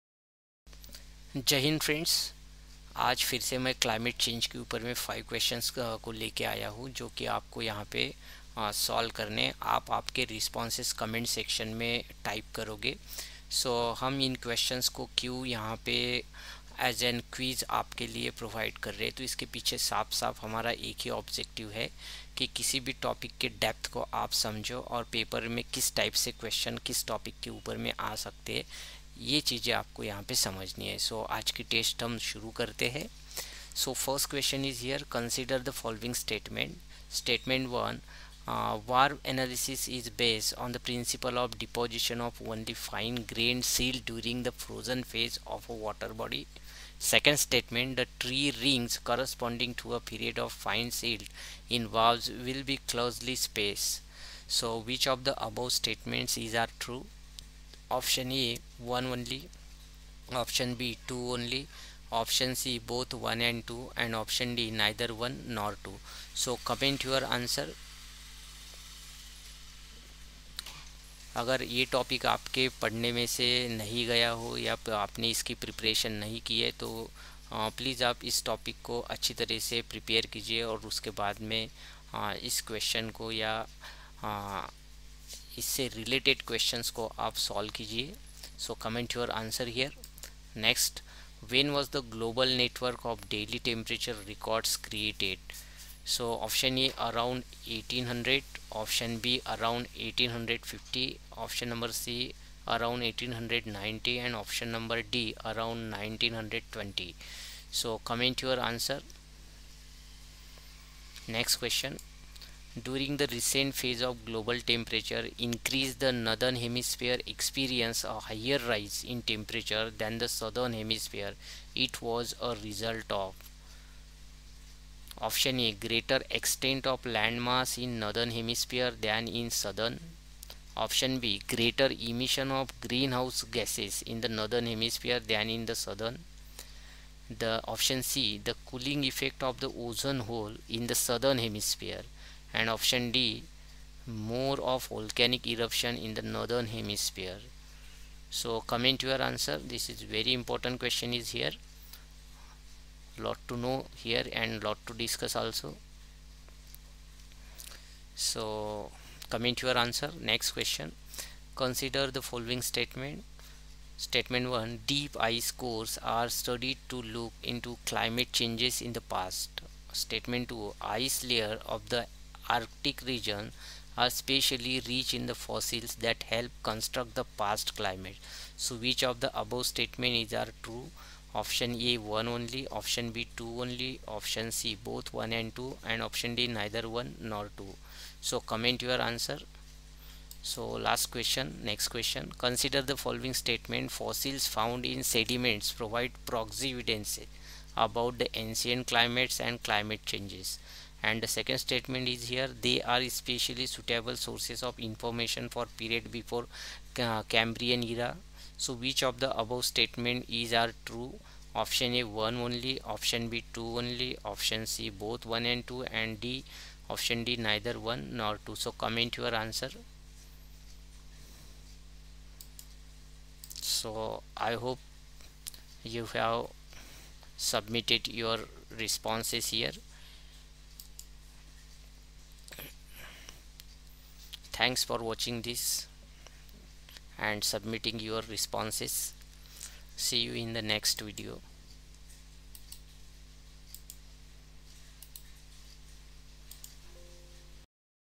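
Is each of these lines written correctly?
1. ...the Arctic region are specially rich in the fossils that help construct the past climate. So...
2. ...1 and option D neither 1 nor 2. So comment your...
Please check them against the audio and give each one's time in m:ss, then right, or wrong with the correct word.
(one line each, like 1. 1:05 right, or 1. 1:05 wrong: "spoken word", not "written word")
1. 2:51 right
2. 3:05 wrong: "2", not "1".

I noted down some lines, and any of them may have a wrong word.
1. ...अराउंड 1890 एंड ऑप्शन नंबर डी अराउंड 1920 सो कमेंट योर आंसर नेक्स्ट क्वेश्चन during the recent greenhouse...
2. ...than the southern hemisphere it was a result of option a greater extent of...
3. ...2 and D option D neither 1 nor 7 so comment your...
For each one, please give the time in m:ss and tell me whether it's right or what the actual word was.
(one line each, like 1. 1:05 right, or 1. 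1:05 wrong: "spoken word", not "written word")
1. 1:42 wrong: "phase", not "greenhouse"
2. 1:59 right
3. 3:35 wrong: "2", not "7".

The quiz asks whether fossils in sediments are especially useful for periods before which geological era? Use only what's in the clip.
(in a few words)
Cambrian era.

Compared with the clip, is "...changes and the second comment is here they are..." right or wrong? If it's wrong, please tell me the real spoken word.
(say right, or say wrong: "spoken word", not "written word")
wrong: "statement", not "comment".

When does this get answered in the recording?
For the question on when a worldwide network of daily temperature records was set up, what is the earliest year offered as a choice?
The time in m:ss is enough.
1:37.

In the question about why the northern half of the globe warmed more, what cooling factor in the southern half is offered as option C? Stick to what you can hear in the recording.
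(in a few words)
Ozone hole.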